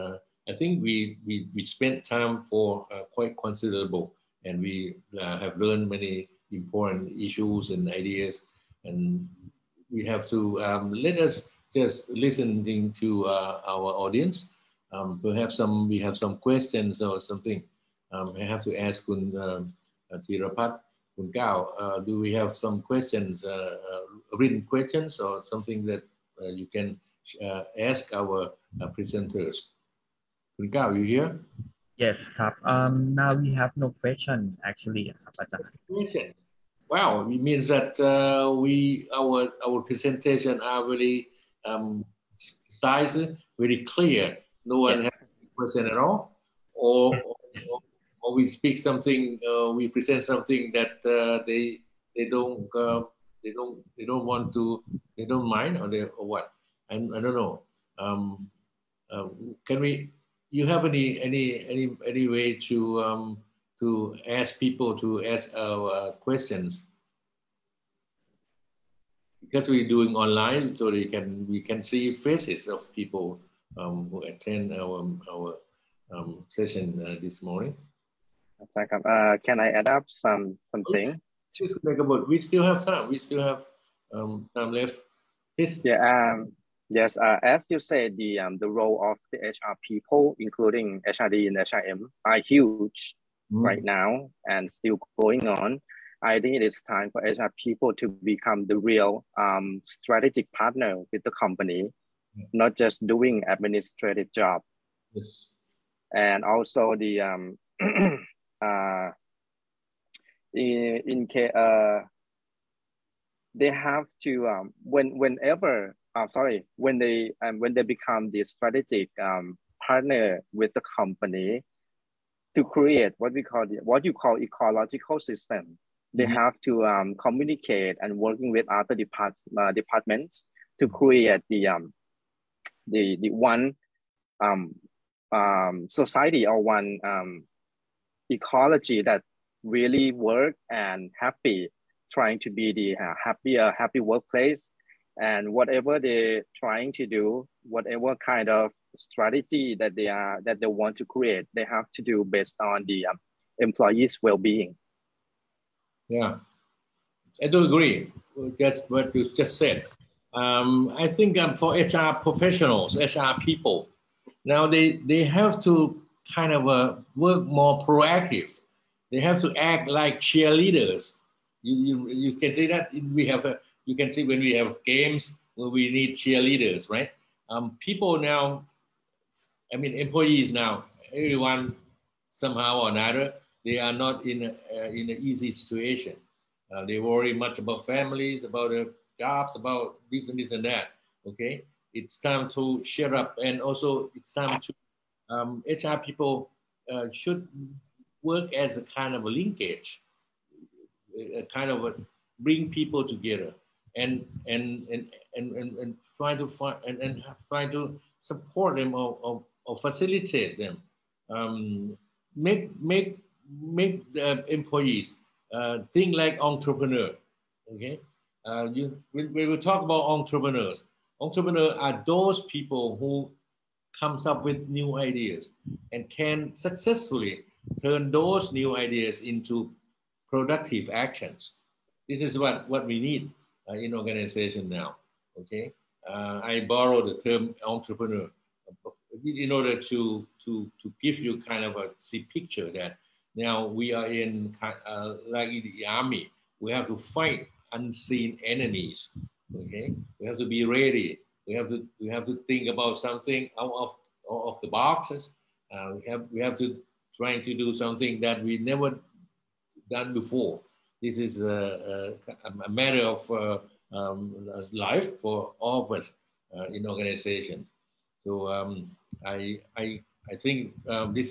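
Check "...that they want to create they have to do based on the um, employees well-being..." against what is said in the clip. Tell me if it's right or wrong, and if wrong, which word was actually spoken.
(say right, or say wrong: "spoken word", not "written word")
right.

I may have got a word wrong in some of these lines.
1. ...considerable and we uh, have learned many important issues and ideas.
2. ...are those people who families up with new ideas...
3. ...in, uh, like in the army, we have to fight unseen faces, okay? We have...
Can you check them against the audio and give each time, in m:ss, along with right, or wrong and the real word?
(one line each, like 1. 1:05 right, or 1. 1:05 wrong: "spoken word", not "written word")
1. 0:03 right
2. 3:41 wrong: "comes", not "families"
3. 4:04 wrong: "enemies", not "faces".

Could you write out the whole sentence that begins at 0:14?
Um, perhaps some we have some questions or something.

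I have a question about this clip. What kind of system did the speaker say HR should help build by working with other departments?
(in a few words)
Ecological system.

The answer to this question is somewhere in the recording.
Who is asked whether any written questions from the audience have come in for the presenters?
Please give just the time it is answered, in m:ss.
0:21.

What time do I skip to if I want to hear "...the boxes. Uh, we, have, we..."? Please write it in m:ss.
4:14.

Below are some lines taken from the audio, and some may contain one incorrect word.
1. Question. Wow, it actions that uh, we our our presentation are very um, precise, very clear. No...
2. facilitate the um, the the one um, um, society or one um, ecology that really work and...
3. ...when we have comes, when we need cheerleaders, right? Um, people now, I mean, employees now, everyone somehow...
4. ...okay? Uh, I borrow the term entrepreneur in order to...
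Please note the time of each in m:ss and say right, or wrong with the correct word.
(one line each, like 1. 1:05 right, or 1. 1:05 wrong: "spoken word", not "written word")
1. 0:35 wrong: "means", not "actions"
2. 2:10 wrong: "create", not "facilitate"
3. 2:54 wrong: "games", not "comes"
4. 3:55 right.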